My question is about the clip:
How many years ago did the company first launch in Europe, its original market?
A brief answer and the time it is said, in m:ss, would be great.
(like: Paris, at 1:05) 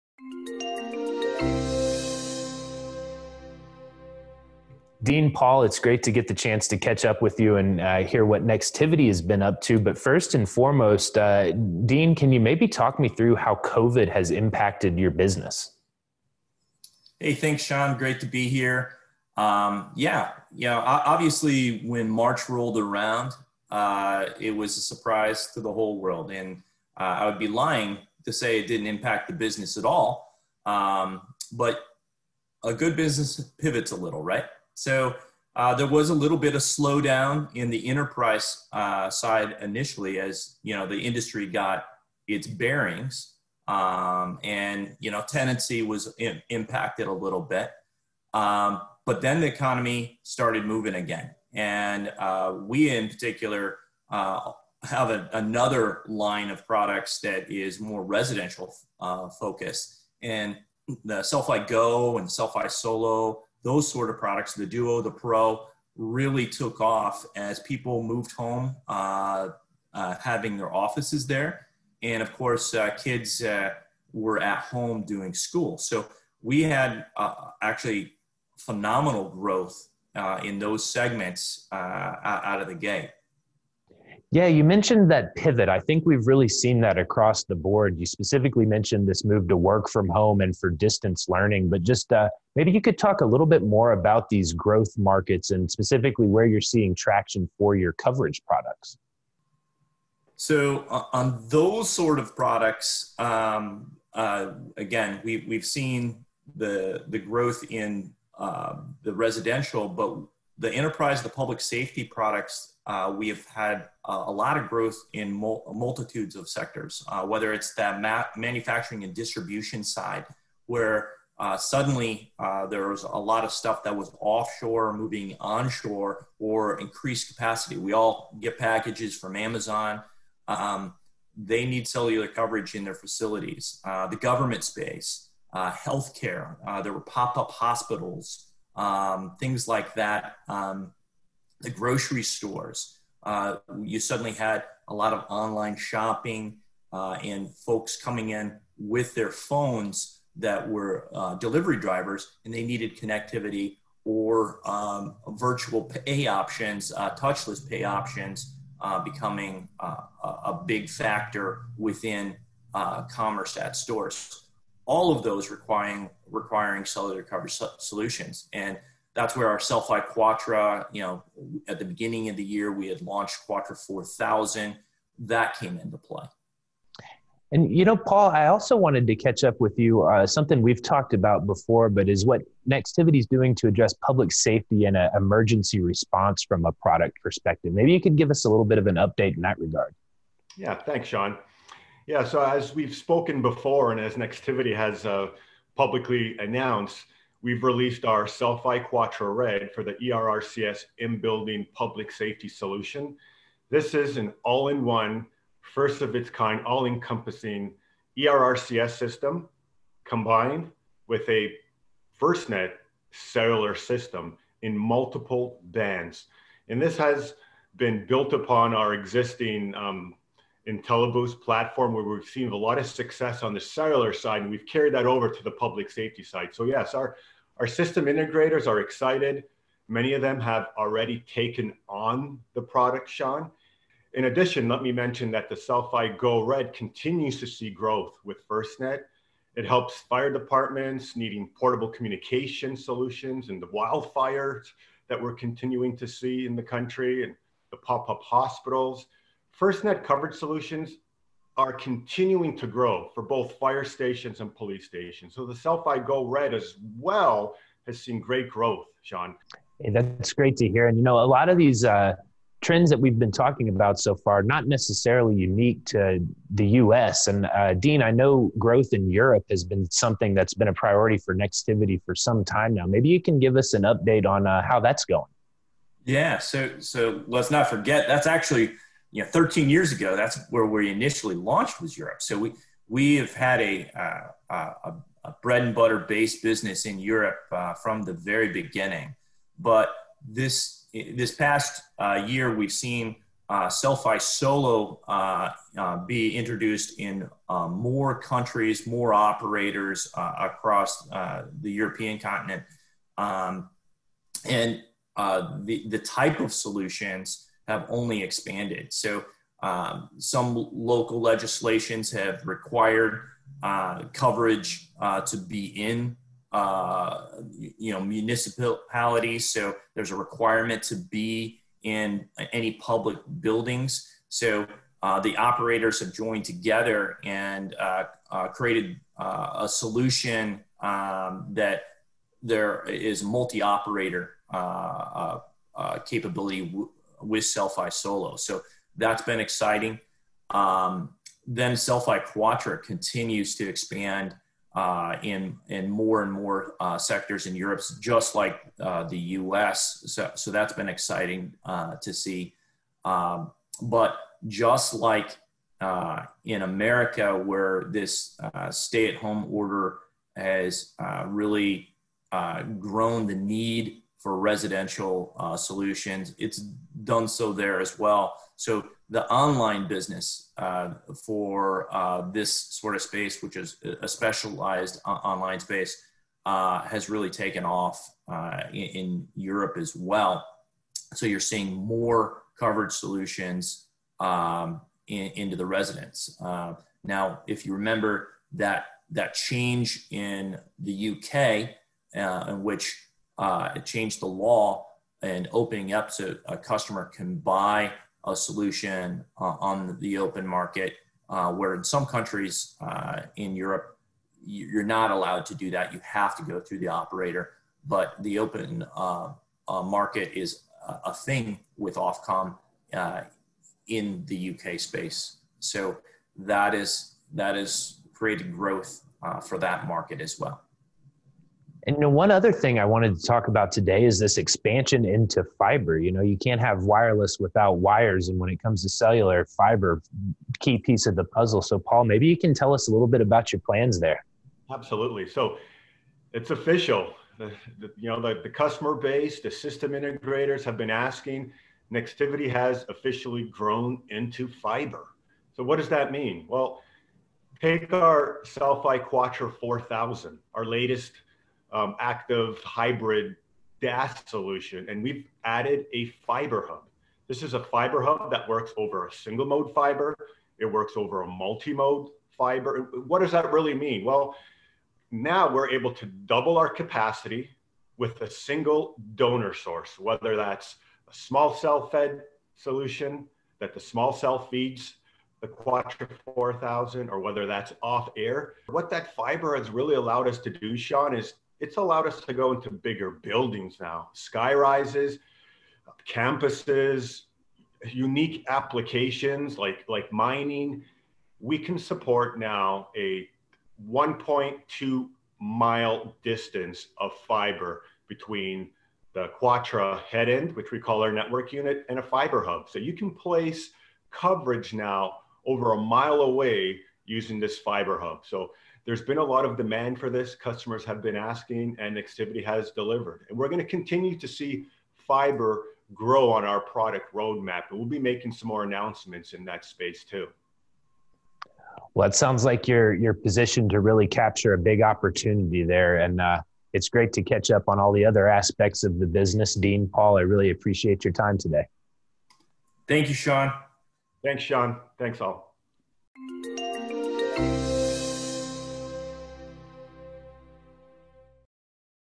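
13, at 4:39.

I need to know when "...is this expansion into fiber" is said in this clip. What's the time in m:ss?
7:04.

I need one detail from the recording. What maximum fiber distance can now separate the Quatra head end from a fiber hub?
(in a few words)
1.2 miles.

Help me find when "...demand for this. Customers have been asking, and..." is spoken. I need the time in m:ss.
8:29.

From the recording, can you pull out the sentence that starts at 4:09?
FirstNet coverage solutions are continuing to grow for both fire stations and police stations.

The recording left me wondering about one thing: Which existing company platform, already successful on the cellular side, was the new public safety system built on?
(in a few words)
IntelliBoost.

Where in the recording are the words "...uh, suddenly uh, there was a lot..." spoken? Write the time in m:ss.
2:01.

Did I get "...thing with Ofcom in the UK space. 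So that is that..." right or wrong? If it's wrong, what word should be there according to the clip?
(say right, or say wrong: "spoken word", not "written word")
right.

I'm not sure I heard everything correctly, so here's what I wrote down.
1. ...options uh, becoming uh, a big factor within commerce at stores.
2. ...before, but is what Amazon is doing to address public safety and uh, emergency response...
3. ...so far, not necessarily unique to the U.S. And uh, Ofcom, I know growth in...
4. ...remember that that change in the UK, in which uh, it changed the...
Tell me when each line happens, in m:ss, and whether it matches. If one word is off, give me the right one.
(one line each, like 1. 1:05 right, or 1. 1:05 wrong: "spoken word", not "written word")
1. 2:37 right
2. 3:01 wrong: "Nextivity", not "Amazon"
3. 4:23 wrong: "Dean", not "Ofcom"
4. 6:27 right.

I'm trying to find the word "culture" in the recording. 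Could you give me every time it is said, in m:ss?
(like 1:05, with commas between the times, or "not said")
not said.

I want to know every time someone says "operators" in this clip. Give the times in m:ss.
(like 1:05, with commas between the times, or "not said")
4:59, 5:25, 5:33, 6:46.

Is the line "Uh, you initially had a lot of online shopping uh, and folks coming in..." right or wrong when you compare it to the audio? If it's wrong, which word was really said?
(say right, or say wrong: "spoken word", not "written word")
wrong: "suddenly", not "initially".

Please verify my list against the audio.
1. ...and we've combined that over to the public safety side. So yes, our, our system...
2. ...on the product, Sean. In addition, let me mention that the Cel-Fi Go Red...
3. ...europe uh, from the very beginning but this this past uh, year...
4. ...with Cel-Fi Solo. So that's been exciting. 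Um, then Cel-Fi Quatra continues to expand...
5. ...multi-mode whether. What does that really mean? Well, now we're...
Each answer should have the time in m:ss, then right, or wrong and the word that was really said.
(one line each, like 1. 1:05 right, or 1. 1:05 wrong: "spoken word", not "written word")
1. 3:44 wrong: "carried", not "combined"
2. 3:51 right
3. 4:46 right
4. 5:37 right
5. 7:41 wrong: "fiber", not "whether".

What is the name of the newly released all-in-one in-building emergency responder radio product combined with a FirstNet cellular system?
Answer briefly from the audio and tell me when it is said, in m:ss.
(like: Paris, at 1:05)
Cel-Fi Quatra Red, at 3:18.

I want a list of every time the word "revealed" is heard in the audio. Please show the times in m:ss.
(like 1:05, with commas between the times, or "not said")
not said.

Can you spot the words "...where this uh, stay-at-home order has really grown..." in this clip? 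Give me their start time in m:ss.
5:57.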